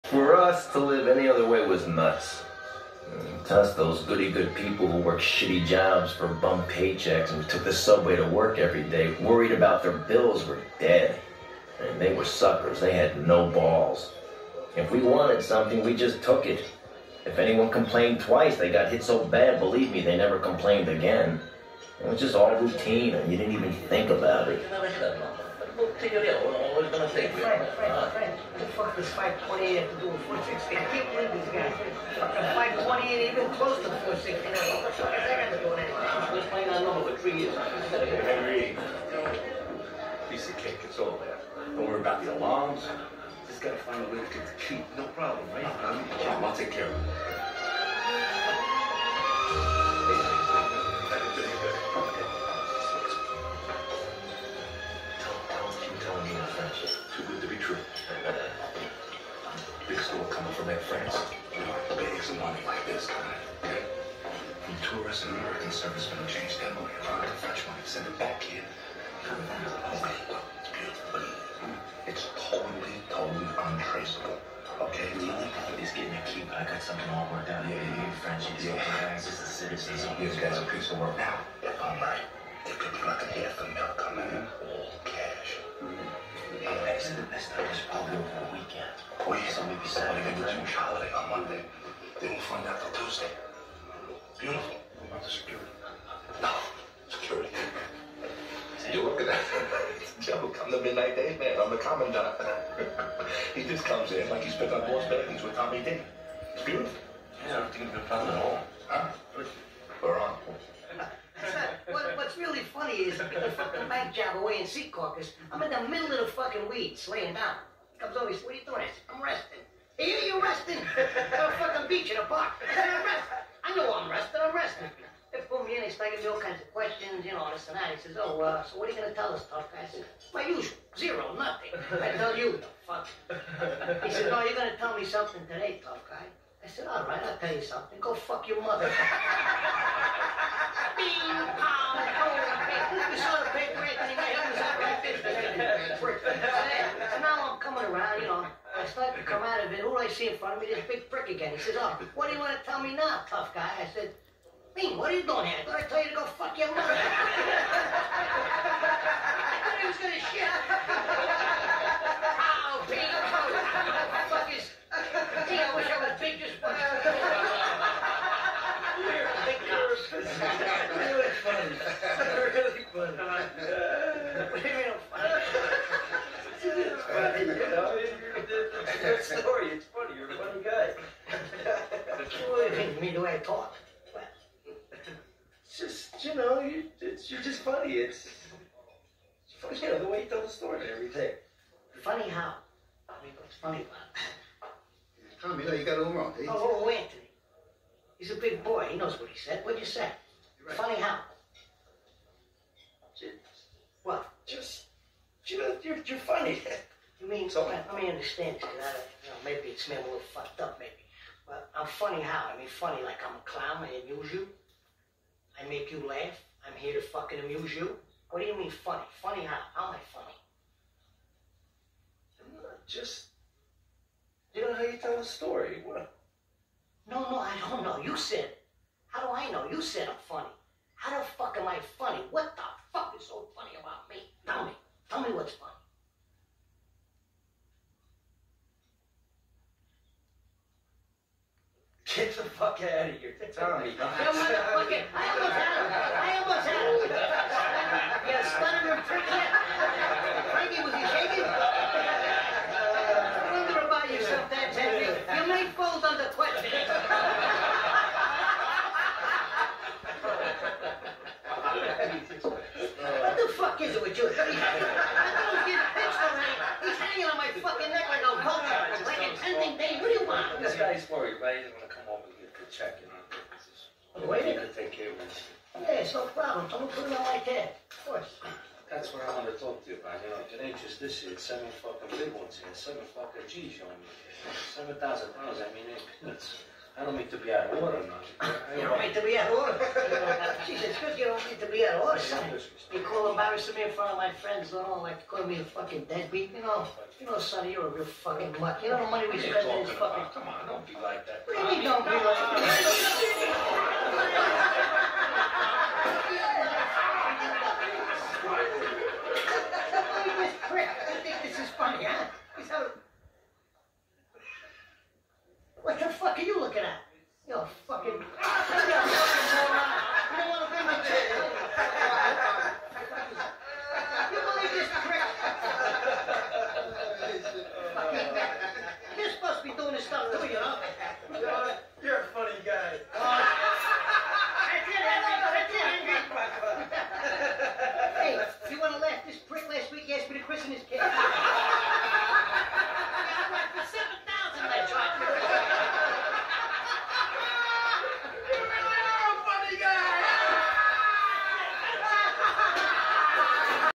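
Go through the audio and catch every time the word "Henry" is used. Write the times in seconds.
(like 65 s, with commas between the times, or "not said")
37 s, 254 s.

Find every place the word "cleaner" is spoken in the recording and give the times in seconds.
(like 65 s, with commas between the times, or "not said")
not said.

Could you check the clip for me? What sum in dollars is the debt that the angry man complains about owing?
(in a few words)
$7,000.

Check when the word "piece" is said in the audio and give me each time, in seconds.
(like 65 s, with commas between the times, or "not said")
40 s, 80 s.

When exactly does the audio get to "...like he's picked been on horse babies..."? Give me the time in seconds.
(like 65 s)
104 s.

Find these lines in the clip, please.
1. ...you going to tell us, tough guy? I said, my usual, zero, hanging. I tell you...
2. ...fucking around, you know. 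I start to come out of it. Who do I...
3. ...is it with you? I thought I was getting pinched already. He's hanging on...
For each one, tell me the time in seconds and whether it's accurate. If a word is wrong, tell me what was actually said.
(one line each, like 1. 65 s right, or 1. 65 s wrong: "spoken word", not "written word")
1. 128 s wrong: "nothing", not "hanging"
2. 147 s wrong: "coming", not "fucking"
3. 263 s right.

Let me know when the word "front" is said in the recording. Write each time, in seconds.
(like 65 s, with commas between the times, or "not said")
150 s, 293 s.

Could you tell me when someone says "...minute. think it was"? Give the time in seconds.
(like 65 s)
274 s.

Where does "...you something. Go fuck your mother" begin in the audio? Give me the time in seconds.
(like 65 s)
137 s.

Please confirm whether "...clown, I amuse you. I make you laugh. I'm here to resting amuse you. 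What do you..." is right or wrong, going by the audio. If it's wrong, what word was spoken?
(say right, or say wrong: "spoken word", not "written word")
wrong: "fucking", not "resting".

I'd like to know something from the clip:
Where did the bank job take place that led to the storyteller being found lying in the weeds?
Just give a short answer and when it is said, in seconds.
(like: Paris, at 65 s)
Secaucus, at 114 s.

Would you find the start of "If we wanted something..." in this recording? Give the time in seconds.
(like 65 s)
14 s.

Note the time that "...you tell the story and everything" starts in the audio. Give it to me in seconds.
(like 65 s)
190 s.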